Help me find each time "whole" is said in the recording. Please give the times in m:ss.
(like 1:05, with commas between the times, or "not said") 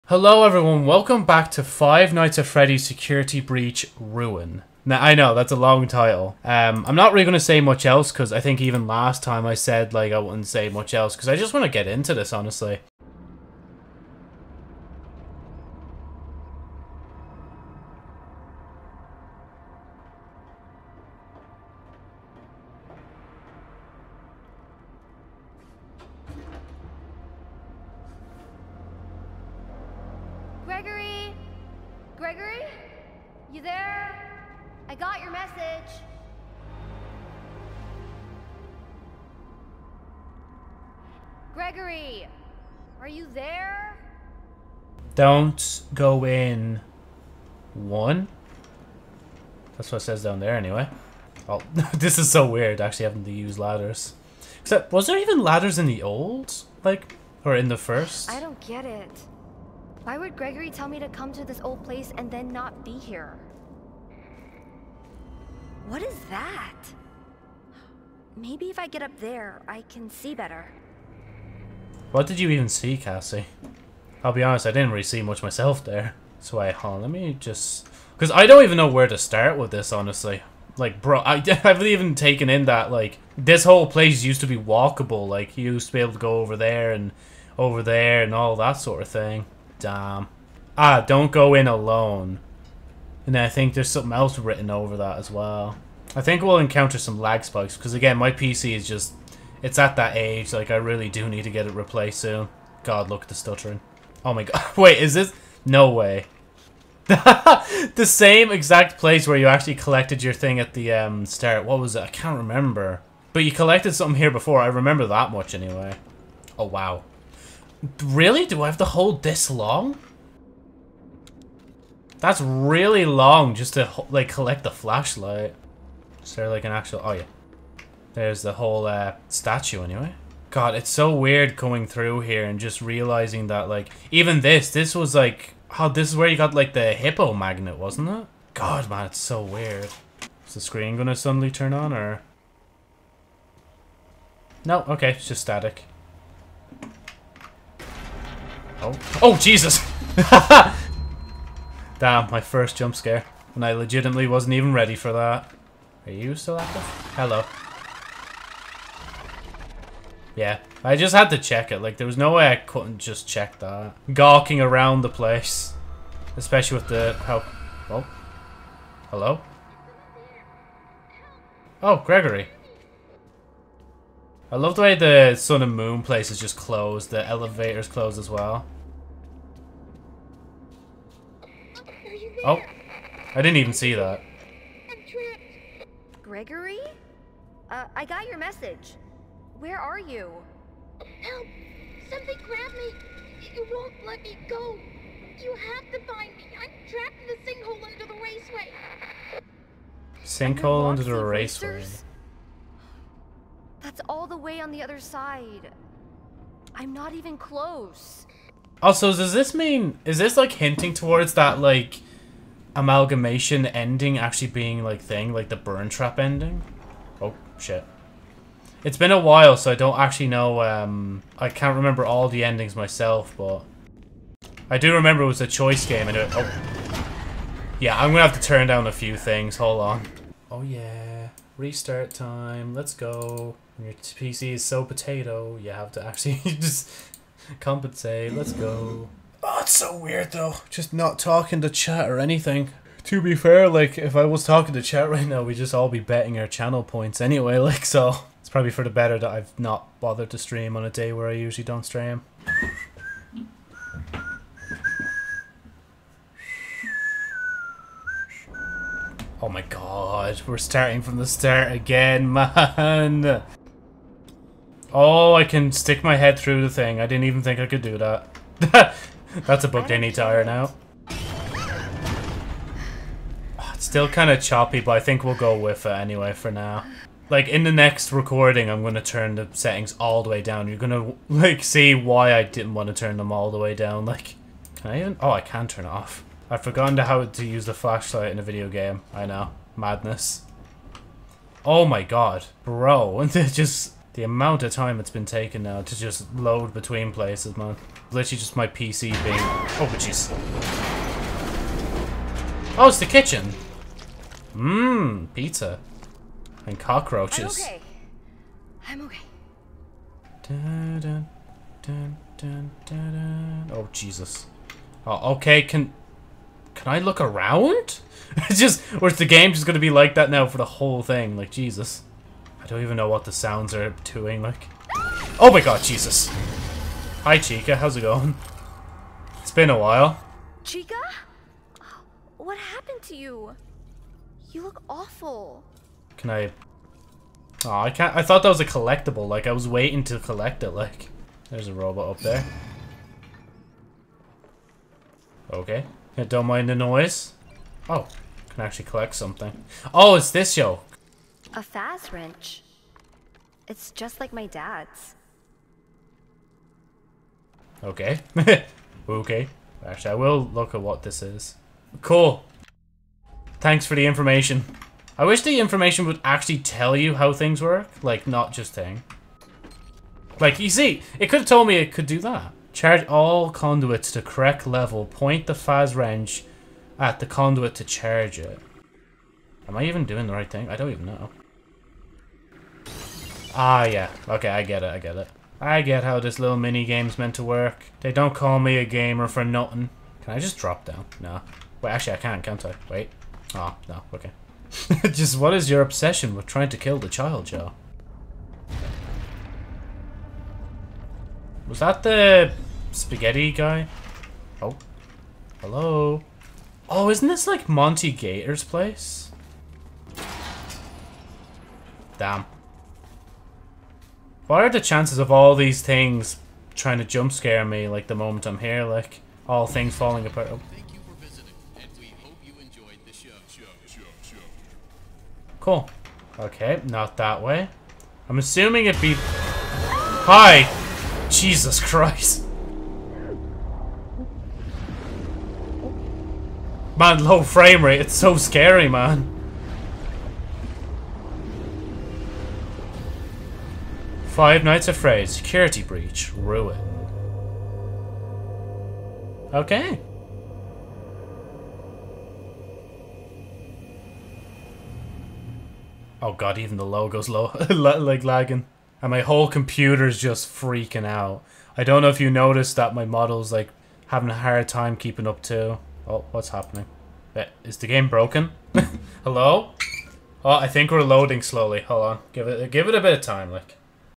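1:23, 2:08, 5:20, 7:39.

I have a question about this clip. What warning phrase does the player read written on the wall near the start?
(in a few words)
Don't go in alone.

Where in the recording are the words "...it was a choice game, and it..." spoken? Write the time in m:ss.
3:45.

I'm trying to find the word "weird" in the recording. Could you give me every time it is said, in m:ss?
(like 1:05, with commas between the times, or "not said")
0:52, 2:11, 2:19, 3:59.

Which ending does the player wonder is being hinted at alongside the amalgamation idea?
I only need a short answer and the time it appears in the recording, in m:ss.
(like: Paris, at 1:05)
Burntrap ending, at 3:35.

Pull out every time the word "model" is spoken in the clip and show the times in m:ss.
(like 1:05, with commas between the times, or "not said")
7:43.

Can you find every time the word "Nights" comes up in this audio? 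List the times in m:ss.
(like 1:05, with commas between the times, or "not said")
0:02, 7:24.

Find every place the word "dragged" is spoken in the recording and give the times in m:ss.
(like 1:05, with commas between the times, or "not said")
not said.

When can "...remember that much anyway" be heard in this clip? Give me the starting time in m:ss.
1:54.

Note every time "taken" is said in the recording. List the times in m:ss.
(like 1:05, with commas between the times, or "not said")
1:22, 4:55.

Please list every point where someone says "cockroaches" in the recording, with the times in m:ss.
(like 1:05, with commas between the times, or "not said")
5:06.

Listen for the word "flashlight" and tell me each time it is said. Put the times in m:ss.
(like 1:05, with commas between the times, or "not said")
2:04, 4:47.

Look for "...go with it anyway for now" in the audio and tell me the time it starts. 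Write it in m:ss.
4:35.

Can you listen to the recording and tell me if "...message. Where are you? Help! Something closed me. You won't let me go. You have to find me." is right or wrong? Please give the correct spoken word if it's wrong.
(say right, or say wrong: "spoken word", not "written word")
wrong: "grabbed", not "closed".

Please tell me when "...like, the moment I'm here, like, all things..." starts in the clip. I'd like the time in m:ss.
6:57.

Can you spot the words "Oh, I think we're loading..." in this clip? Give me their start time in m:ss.
7:50.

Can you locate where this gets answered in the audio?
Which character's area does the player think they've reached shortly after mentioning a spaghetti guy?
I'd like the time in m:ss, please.
6:47.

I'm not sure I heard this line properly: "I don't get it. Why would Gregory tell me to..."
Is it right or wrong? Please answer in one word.
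right.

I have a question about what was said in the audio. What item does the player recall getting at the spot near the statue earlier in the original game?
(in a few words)
Hippo magnet.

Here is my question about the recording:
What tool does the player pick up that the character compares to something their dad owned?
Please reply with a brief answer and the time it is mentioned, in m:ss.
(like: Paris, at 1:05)
Faz-Wrench, at 5:51.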